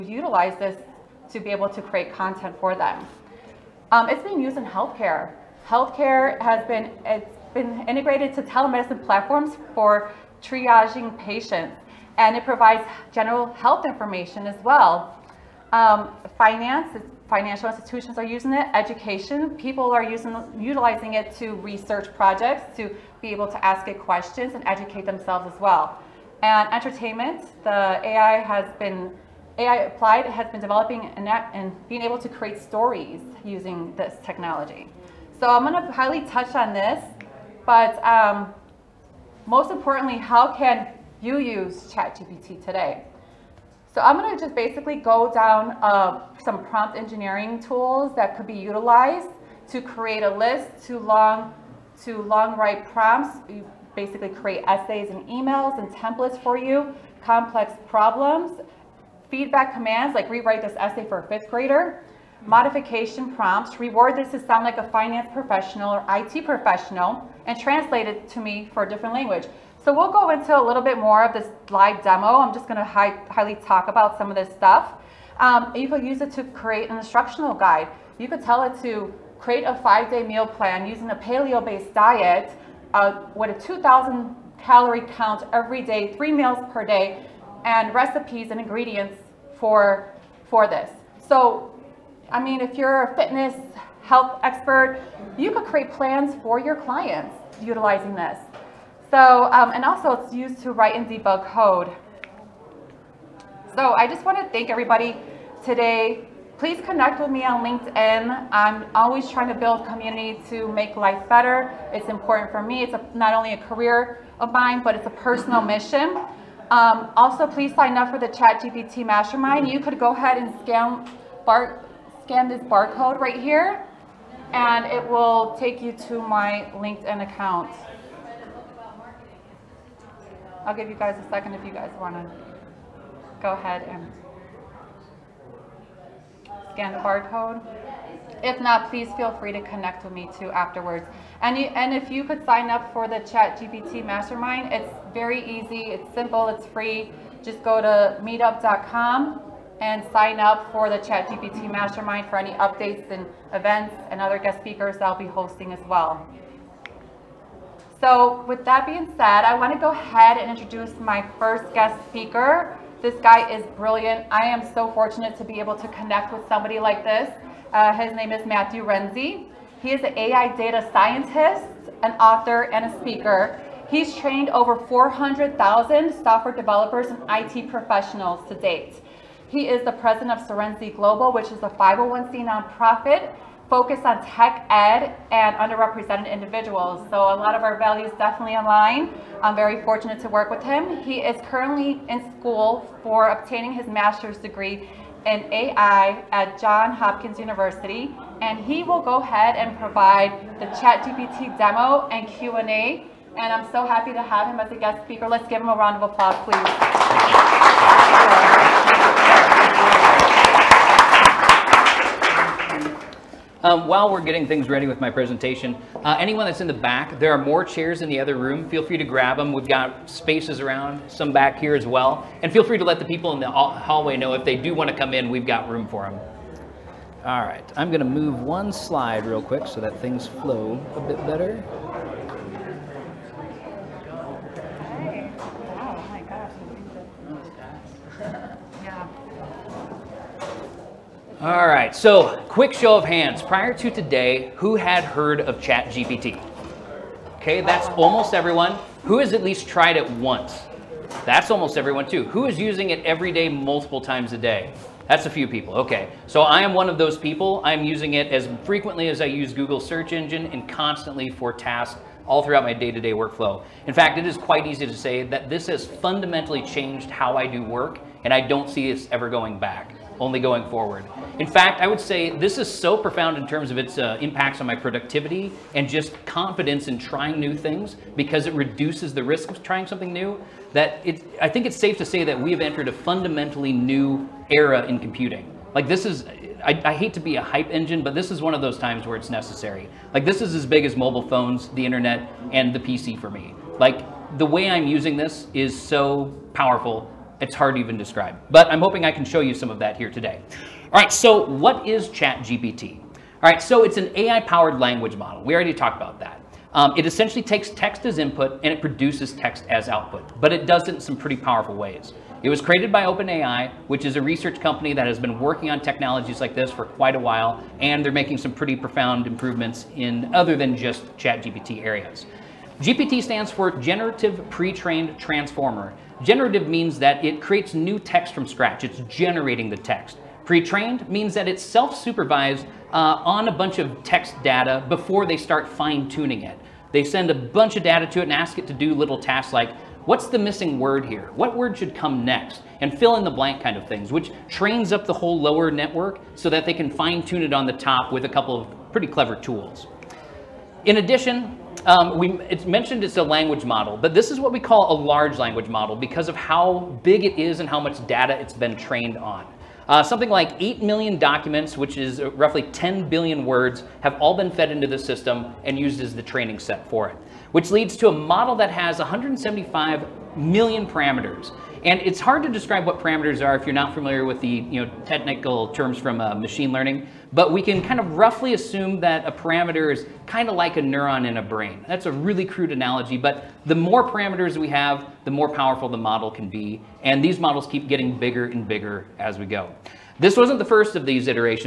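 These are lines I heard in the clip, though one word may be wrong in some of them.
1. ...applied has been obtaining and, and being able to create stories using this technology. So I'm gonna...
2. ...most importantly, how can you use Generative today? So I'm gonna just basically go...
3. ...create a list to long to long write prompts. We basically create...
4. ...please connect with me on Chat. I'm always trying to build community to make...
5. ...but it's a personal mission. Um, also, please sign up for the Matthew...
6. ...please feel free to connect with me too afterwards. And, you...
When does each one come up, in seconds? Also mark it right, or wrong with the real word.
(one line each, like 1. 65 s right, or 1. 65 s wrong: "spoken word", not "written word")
1. 29 s wrong: "developing", not "obtaining"
2. 39 s wrong: "ChatGPT", not "Generative"
3. 49 s right
4. 106 s wrong: "LinkedIn", not "Chat"
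5. 114 s wrong: "ChatGPT", not "Matthew"
6. 138 s right.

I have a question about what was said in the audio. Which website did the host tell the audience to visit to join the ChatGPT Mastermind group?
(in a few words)
meetup.com.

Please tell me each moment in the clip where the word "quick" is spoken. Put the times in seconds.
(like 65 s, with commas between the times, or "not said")
229 s, 242 s.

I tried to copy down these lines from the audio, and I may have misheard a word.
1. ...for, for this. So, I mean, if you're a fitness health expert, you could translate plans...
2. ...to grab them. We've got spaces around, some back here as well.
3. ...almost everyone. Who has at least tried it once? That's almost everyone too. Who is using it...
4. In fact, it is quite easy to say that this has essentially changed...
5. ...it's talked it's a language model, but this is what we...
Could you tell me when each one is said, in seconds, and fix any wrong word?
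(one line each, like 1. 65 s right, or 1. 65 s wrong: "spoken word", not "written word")
1. 89 s wrong: "create", not "translate"
2. 218 s right
3. 247 s right
4. 263 s wrong: "fundamentally", not "essentially"
5. 352 s wrong: "mentioned", not "talked".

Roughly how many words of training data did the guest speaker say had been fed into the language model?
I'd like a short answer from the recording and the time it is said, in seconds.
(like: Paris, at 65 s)
10 billion, at 362 s.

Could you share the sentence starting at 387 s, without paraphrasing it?
And these models keep getting bigger and bigger as we go.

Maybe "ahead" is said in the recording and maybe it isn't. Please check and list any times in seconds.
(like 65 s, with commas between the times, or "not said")
120 s, 133 s, 159 s, 199 s.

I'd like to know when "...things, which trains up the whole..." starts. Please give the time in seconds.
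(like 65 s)
343 s.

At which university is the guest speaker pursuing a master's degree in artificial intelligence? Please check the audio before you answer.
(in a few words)
Johns Hopkins University.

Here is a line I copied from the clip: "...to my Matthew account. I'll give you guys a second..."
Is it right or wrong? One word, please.
wrong.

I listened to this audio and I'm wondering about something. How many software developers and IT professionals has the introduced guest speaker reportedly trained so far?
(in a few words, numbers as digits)
400,000.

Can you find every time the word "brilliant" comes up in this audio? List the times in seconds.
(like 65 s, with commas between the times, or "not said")
163 s.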